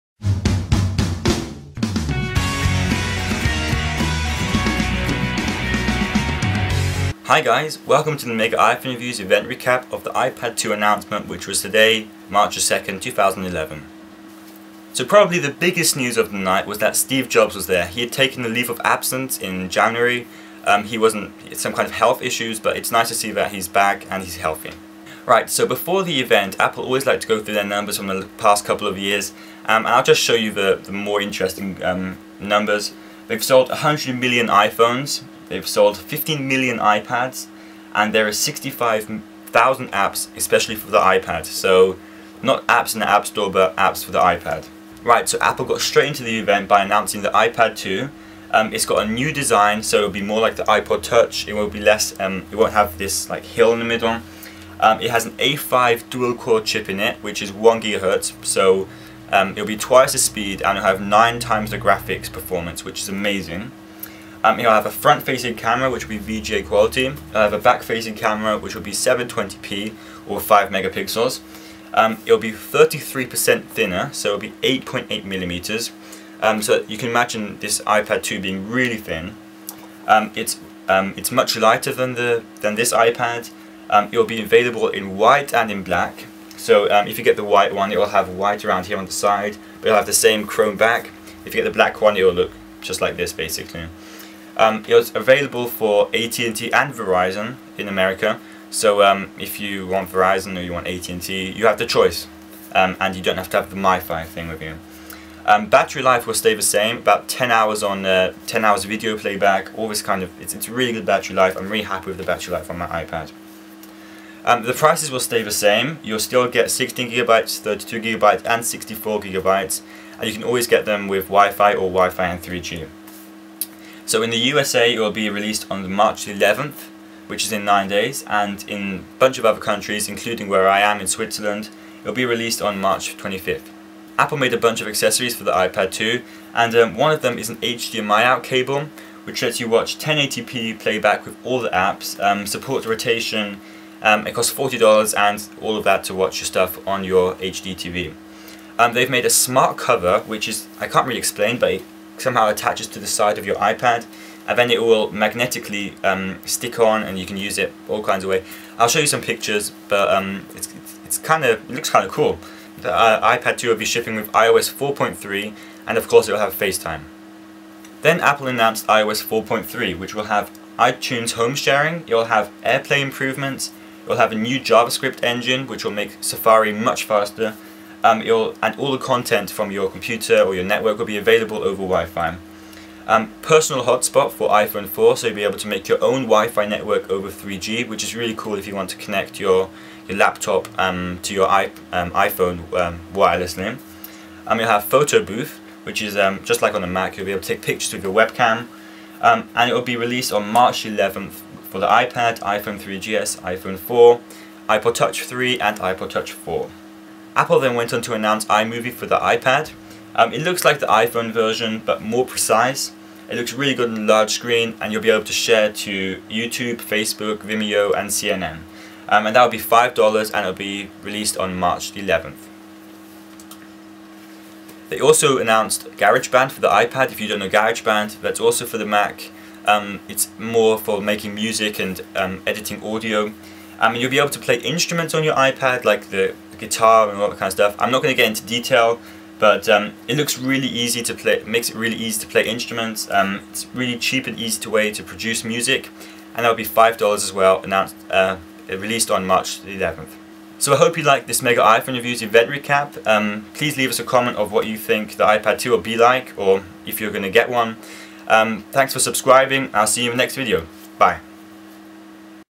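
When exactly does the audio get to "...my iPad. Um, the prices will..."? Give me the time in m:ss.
1:52.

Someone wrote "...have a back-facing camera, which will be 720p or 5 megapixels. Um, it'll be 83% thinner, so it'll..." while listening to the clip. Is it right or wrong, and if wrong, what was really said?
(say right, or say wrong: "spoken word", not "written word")
wrong: "33", not "83".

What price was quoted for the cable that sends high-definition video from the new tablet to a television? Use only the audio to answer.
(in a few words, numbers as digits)
$40.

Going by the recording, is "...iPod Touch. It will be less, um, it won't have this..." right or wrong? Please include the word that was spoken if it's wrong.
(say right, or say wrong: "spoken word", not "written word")
right.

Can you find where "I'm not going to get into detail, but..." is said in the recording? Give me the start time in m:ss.
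3:57.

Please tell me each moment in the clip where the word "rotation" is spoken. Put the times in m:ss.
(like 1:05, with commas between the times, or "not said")
2:22.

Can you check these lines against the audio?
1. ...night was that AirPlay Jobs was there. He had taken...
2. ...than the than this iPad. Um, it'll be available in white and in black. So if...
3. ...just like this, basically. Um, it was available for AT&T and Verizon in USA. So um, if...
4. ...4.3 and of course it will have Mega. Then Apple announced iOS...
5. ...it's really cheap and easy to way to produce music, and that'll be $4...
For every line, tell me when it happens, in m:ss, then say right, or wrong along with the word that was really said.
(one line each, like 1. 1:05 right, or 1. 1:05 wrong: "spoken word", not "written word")
1. 0:16 wrong: "Steve", not "AirPlay"
2. 1:21 right
3. 1:32 wrong: "America", not "USA"
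4. 2:44 wrong: "FaceTime", not "Mega"
5. 4:03 wrong: "5", not "4".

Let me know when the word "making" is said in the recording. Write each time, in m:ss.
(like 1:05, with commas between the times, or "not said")
3:51.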